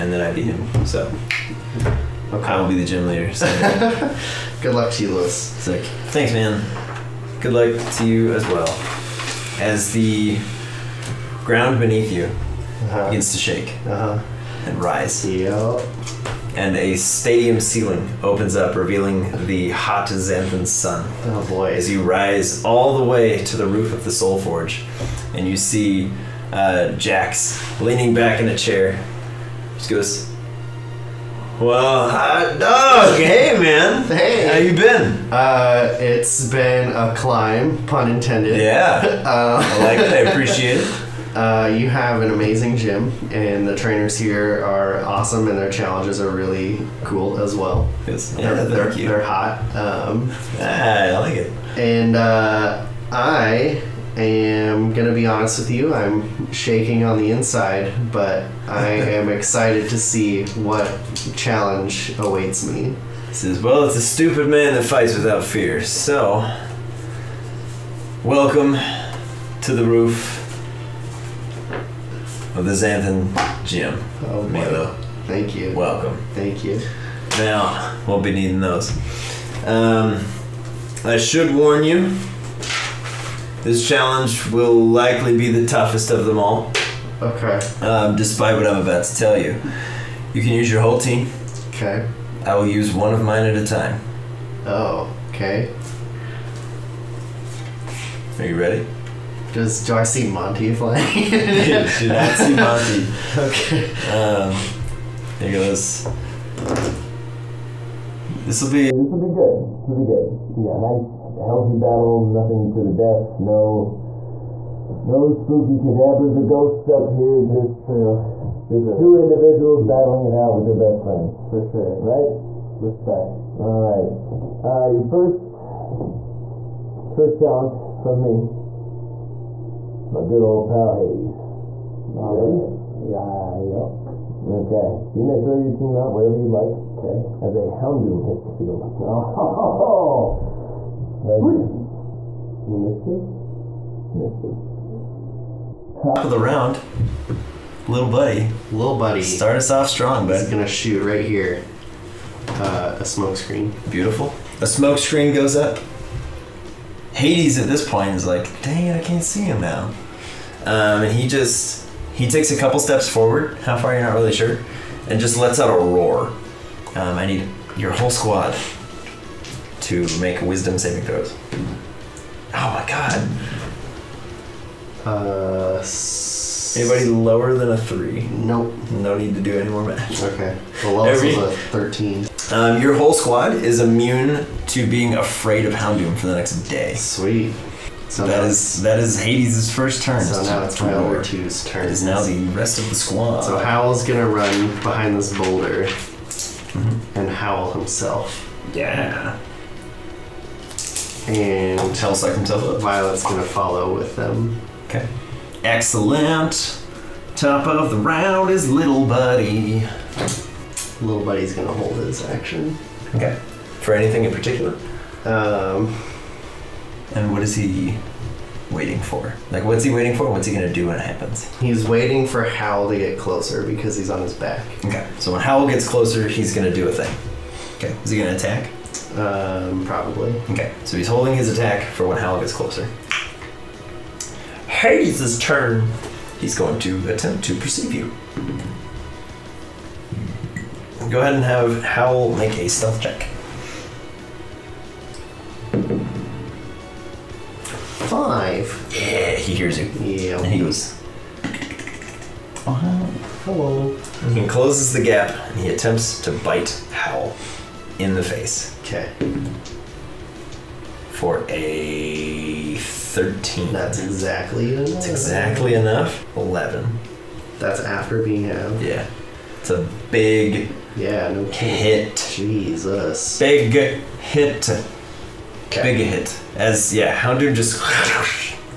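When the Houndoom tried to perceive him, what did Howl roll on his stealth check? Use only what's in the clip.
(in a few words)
5.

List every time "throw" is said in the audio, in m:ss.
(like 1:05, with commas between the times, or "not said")
2:15, 2:51.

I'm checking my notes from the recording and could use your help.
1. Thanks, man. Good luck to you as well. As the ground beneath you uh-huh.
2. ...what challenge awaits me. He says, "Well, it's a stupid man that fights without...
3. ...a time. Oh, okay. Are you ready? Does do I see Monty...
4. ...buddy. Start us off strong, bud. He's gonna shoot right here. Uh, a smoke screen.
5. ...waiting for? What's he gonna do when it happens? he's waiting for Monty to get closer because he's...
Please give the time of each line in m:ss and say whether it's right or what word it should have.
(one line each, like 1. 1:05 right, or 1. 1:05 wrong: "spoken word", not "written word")
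1. 0:06 right
2. 1:00 right
3. 1:33 right
4. 2:28 right
5. 3:39 wrong: "Howl", not "Monty".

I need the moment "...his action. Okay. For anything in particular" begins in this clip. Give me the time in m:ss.
3:31.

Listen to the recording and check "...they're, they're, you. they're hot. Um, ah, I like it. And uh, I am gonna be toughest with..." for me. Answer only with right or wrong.
wrong.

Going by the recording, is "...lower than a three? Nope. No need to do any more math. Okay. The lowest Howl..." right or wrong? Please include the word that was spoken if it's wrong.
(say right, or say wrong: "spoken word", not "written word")
wrong: "Every", not "Howl".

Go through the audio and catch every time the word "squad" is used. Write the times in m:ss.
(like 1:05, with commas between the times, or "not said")
2:48, 3:03, 3:12.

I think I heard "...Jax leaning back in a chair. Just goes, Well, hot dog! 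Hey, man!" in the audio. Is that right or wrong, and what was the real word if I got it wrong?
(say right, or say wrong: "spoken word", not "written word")
right.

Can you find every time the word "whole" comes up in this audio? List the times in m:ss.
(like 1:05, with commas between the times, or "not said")
1:30, 2:47, 3:02.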